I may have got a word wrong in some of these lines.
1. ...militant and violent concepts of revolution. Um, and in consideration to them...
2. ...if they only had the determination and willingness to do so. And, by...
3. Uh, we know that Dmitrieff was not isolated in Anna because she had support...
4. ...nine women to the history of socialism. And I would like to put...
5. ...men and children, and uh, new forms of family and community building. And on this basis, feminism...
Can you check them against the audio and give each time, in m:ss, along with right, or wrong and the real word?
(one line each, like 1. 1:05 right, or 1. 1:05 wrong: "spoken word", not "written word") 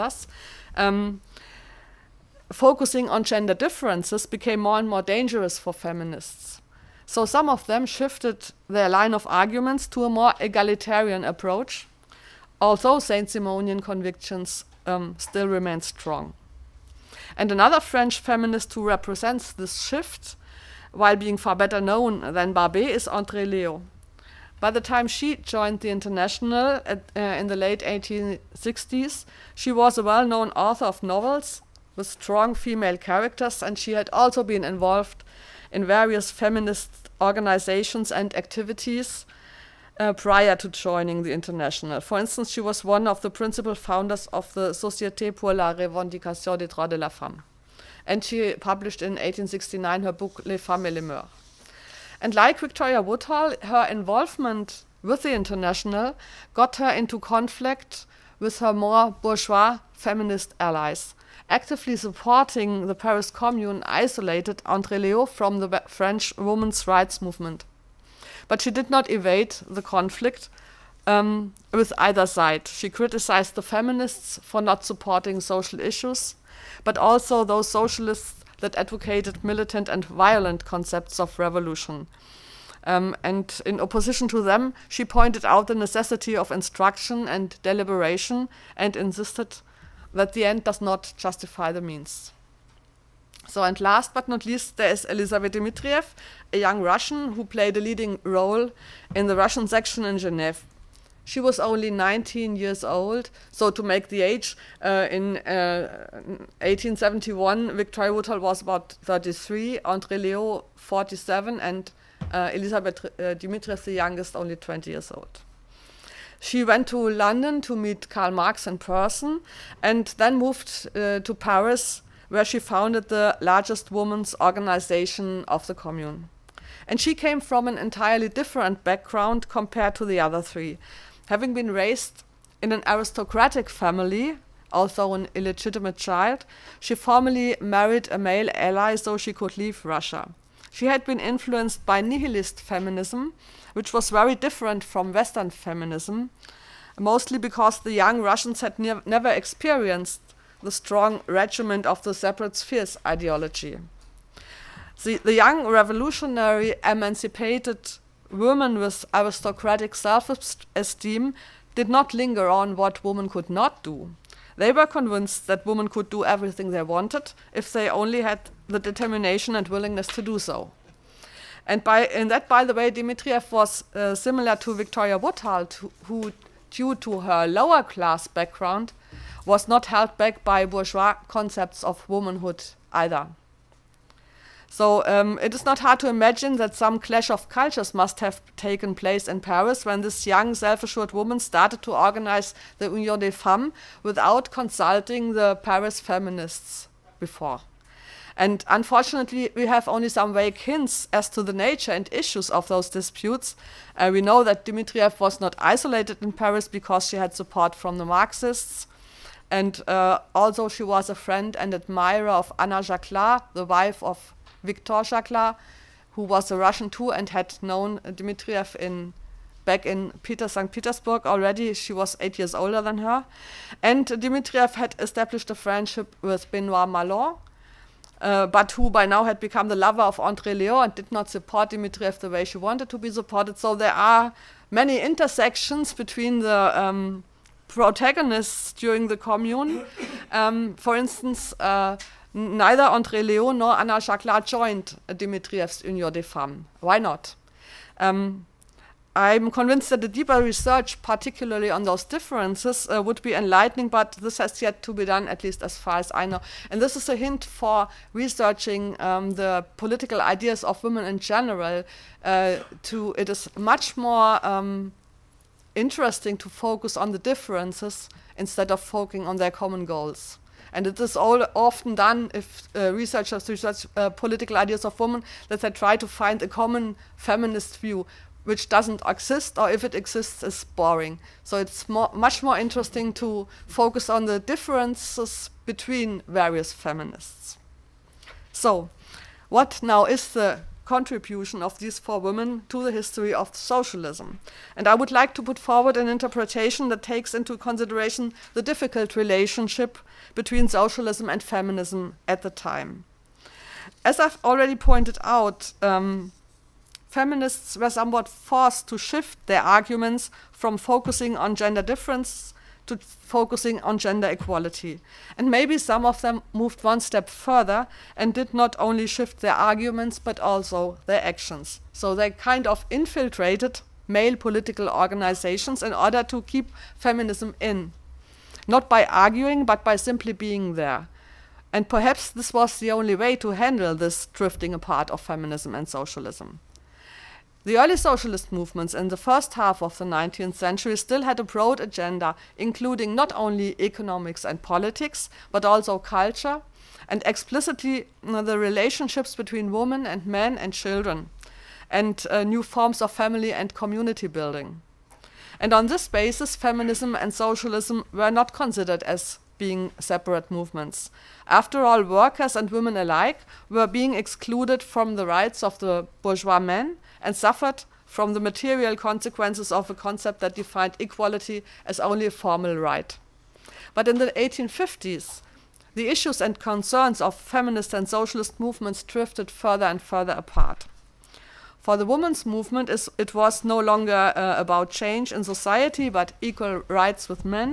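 1. 1:19 wrong: "opposition", not "consideration"
2. 2:47 right
3. 3:23 wrong: "Paris", not "Anna"
4. 4:51 wrong: "four", not "nine"
5. 5:50 right.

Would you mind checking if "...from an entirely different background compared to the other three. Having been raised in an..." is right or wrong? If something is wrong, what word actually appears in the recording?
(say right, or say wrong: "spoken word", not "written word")
right.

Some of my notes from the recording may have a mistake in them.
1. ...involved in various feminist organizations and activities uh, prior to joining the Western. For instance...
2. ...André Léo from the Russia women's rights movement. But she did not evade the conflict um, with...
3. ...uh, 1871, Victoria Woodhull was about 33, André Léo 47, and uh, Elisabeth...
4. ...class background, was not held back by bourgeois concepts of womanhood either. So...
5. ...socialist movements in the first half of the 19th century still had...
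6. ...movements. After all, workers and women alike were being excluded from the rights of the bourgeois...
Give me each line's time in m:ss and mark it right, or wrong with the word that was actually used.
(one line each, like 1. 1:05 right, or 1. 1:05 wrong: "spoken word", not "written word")
1. 0:34 wrong: "International", not "Western"
2. 1:04 wrong: "French", not "Russia"
3. 1:45 right
4. 2:57 right
5. 5:37 right
6. 6:00 right.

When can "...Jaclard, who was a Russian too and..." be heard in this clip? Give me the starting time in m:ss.
3:35.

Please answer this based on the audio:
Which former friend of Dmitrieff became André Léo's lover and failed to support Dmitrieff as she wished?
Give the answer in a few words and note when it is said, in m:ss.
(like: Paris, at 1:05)
Benoit Malon, at 3:46.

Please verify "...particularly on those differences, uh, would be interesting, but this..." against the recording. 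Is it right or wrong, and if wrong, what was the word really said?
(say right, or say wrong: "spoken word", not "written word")
wrong: "enlightening", not "interesting".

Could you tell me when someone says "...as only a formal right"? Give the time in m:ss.
6:11.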